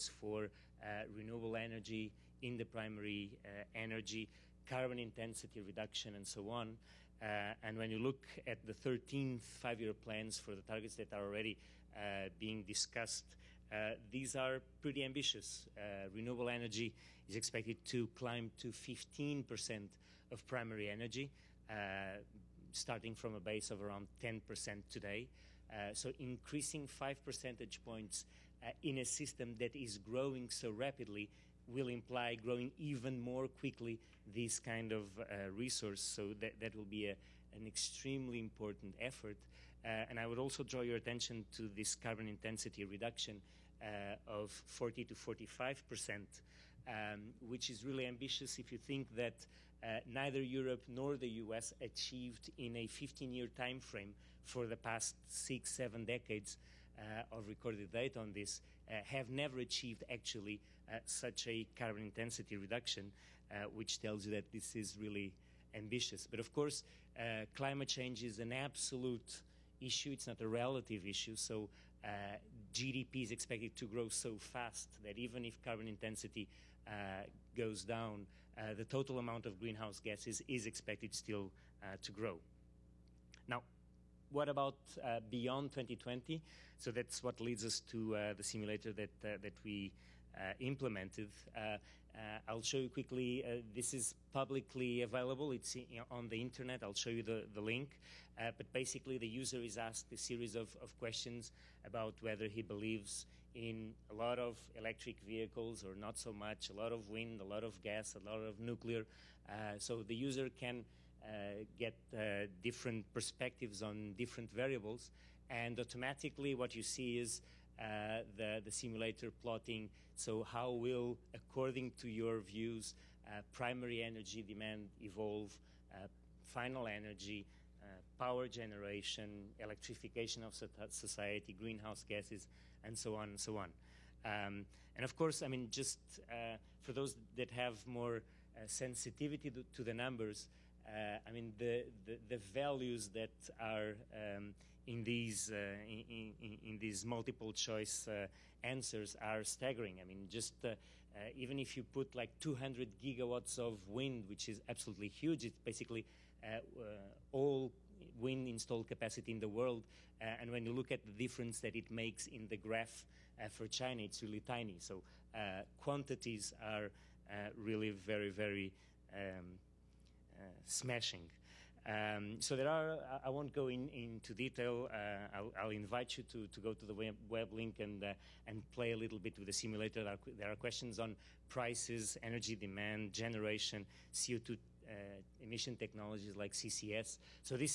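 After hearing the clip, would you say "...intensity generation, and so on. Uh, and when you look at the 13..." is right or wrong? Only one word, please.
wrong.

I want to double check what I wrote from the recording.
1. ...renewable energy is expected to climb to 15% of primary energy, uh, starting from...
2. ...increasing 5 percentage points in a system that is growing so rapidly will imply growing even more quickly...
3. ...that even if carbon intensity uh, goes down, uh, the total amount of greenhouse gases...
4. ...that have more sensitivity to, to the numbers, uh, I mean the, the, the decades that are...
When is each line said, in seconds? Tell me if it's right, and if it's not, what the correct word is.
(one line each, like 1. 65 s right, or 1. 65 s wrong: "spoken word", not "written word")
1. 16 s right
2. 26 s right
3. 75 s right
4. 137 s wrong: "values", not "decades".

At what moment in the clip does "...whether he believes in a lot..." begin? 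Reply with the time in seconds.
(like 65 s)
102 s.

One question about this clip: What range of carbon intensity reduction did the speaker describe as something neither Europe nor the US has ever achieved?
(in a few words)
40 to 45 percent.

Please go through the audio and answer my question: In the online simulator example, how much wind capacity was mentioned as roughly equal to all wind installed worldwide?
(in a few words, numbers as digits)
200 gigawatts.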